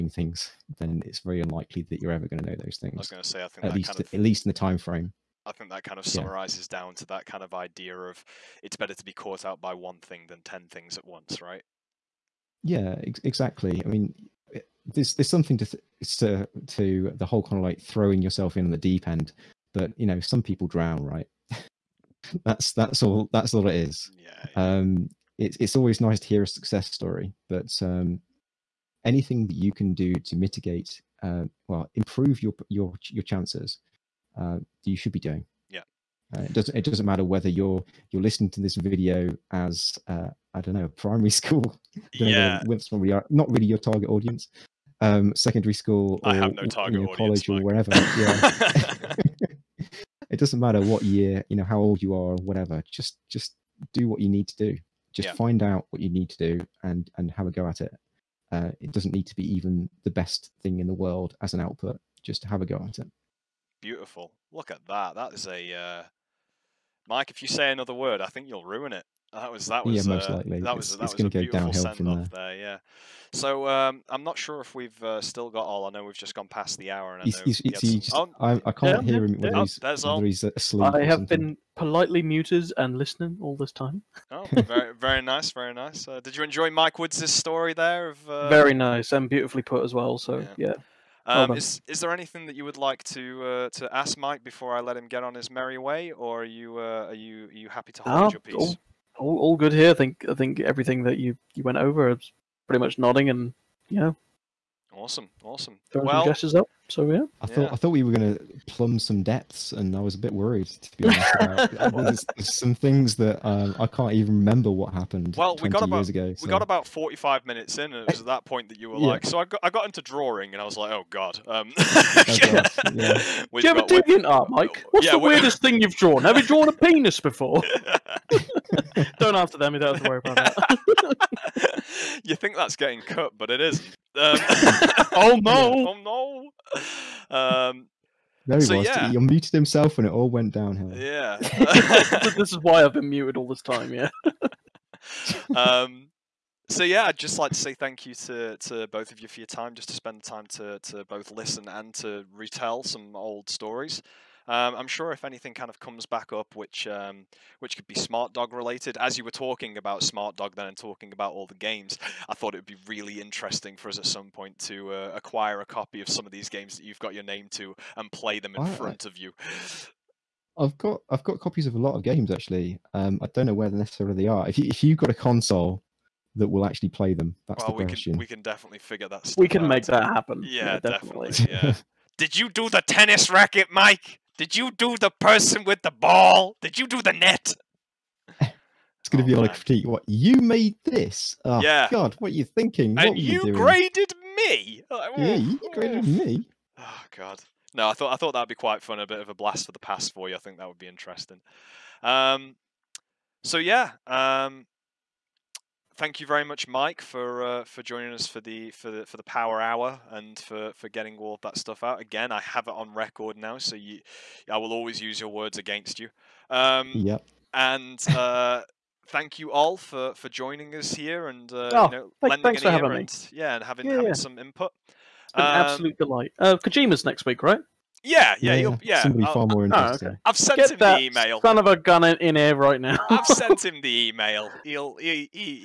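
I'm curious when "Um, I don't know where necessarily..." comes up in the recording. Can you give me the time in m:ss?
2:52.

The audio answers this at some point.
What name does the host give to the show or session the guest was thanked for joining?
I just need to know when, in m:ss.
3:29.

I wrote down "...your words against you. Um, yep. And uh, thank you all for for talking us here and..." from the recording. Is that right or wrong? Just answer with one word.
wrong.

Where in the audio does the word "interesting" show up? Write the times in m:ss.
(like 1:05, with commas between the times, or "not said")
2:43, 3:20, 3:49.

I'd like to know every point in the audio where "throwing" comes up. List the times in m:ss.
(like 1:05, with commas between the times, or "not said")
0:17, 1:45.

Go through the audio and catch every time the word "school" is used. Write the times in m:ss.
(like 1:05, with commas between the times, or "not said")
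0:41, 0:45.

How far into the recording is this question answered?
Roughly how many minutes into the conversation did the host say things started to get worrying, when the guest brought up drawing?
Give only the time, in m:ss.
1:56.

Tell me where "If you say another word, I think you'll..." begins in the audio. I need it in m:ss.
1:07.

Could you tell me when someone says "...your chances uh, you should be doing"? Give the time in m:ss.
0:33.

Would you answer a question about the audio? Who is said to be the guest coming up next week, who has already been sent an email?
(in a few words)
Kojima.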